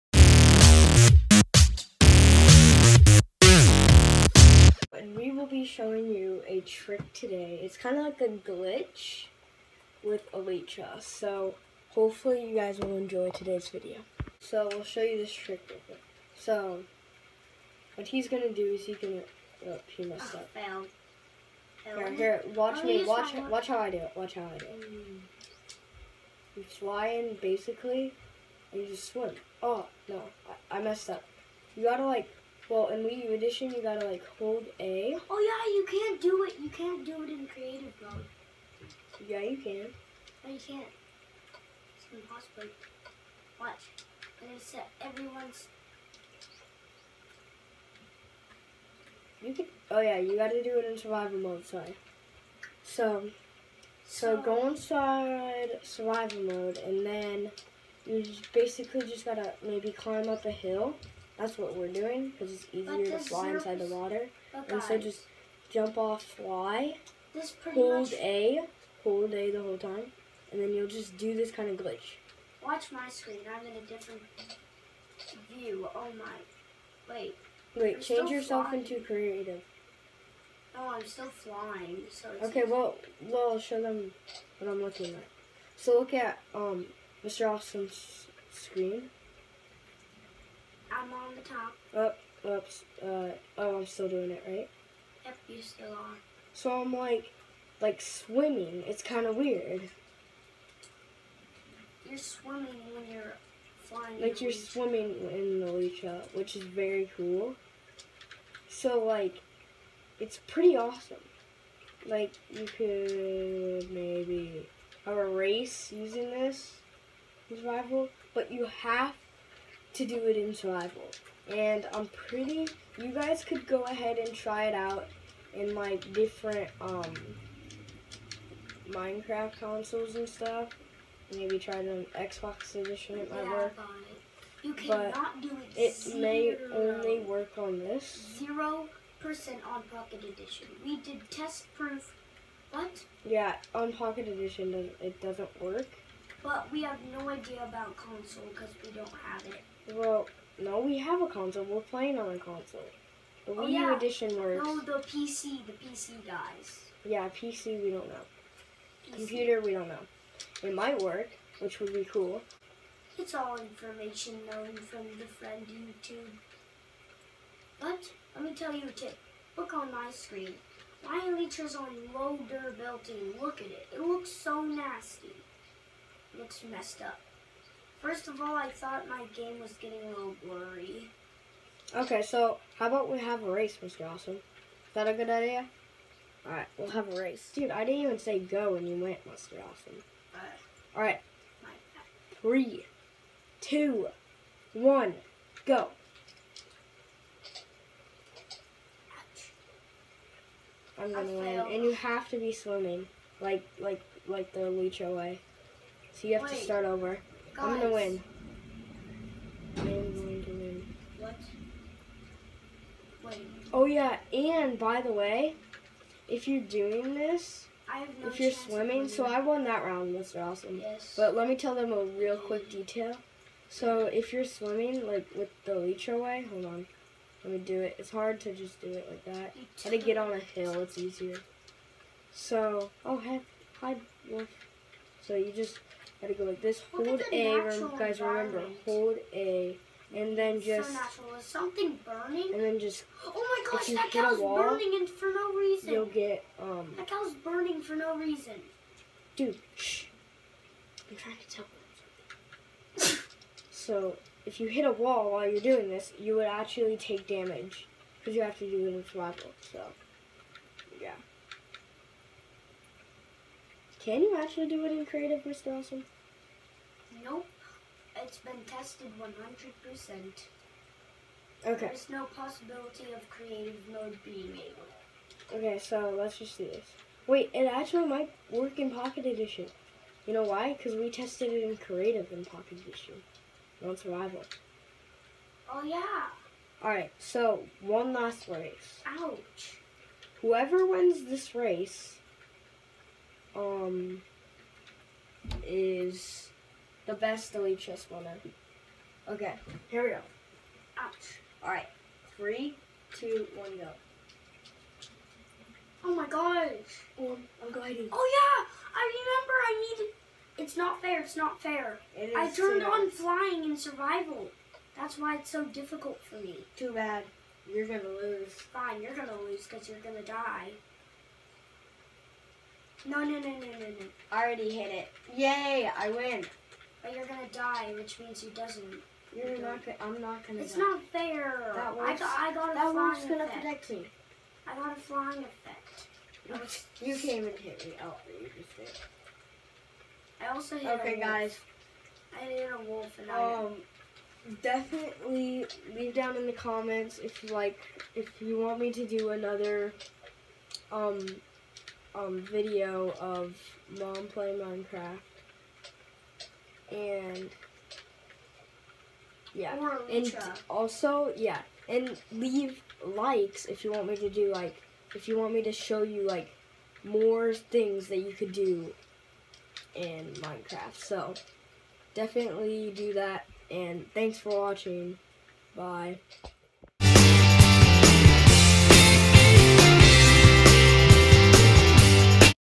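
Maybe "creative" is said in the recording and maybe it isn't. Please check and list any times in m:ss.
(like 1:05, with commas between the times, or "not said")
0:37, 1:19, 4:25, 4:33, 4:41.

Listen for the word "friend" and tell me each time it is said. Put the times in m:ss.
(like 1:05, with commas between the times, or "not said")
2:45.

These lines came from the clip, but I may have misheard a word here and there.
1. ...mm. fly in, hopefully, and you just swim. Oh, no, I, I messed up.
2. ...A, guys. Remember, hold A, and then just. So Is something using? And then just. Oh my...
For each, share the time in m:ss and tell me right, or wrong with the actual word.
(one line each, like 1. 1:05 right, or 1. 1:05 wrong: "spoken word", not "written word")
1. 0:26 wrong: "basically", not "hopefully"
2. 3:57 wrong: "burning", not "using".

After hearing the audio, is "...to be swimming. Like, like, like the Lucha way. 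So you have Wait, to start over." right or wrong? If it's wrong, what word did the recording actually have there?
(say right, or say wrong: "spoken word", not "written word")
right.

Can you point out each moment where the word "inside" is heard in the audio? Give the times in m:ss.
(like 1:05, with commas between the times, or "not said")
0:54, 1:03.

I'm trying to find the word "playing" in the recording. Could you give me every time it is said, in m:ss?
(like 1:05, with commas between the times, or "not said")
2:31, 5:54.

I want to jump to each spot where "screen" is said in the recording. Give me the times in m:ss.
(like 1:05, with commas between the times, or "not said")
1:13, 1:28, 2:50.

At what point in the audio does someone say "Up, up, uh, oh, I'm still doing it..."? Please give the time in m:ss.
1:31.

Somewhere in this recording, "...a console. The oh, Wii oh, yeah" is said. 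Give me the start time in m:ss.
2:32.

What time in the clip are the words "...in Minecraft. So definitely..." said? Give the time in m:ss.
6:09.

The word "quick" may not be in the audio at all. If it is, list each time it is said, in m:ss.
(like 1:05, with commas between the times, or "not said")
0:15, 3:42.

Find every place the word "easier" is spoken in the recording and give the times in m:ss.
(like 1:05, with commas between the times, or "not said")
1:02, 3:50.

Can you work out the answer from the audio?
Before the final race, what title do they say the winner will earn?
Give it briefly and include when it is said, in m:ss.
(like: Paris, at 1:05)
Best delete chest winner, at 4:57.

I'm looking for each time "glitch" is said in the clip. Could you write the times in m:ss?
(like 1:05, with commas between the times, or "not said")
0:08, 1:11.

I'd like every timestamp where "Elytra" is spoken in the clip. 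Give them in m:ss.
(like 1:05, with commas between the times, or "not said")
0:10, 1:45, 2:51, 3:45.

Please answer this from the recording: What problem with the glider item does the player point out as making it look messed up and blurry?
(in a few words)
Low durability.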